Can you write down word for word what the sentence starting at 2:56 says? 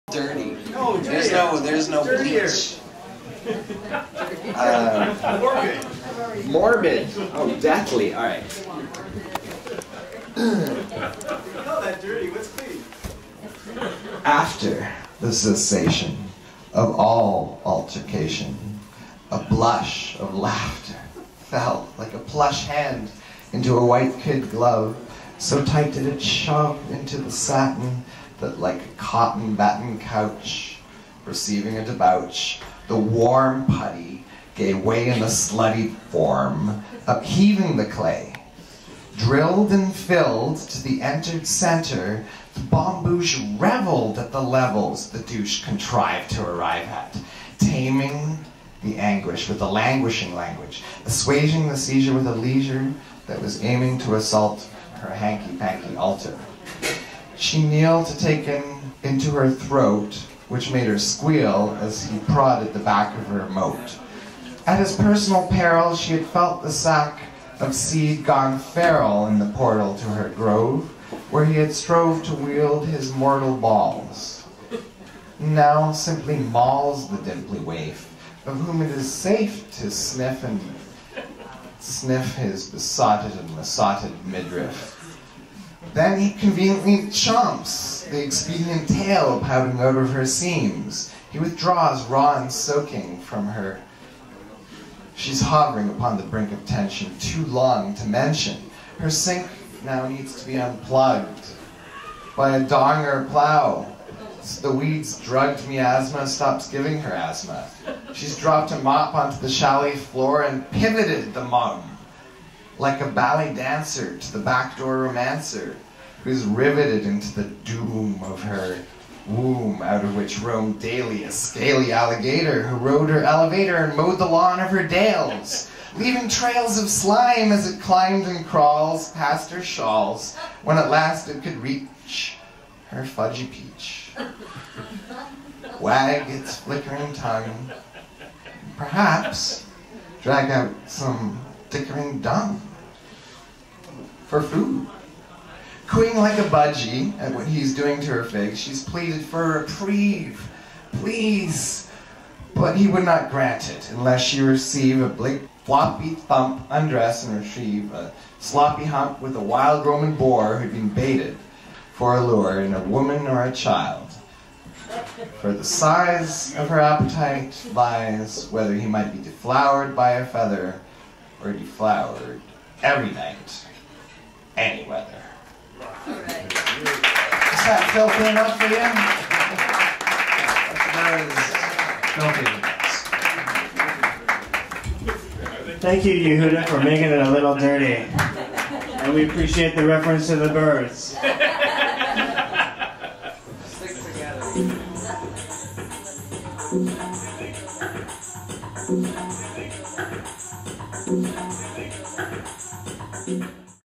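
Is that filthy enough for you?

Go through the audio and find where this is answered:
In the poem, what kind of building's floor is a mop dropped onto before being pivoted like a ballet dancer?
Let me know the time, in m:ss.
1:49.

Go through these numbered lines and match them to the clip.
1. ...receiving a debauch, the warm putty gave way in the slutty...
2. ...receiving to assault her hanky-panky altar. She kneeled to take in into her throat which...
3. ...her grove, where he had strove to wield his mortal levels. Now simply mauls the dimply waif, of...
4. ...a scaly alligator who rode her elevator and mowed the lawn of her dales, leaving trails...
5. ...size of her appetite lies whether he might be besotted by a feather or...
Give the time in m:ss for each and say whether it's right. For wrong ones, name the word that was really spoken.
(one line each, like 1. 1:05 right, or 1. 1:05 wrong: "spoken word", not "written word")
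1. 0:31 right
2. 0:53 wrong: "aiming", not "receiving"
3. 1:10 wrong: "balls", not "levels"
4. 2:01 right
5. 2:45 wrong: "deflowered", not "besotted".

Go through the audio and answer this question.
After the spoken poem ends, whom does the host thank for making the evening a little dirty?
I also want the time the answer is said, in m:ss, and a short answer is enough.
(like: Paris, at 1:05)
Yehudah, at 3:06.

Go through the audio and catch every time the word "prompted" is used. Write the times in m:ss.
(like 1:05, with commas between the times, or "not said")
not said.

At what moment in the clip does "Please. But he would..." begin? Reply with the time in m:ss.
2:30.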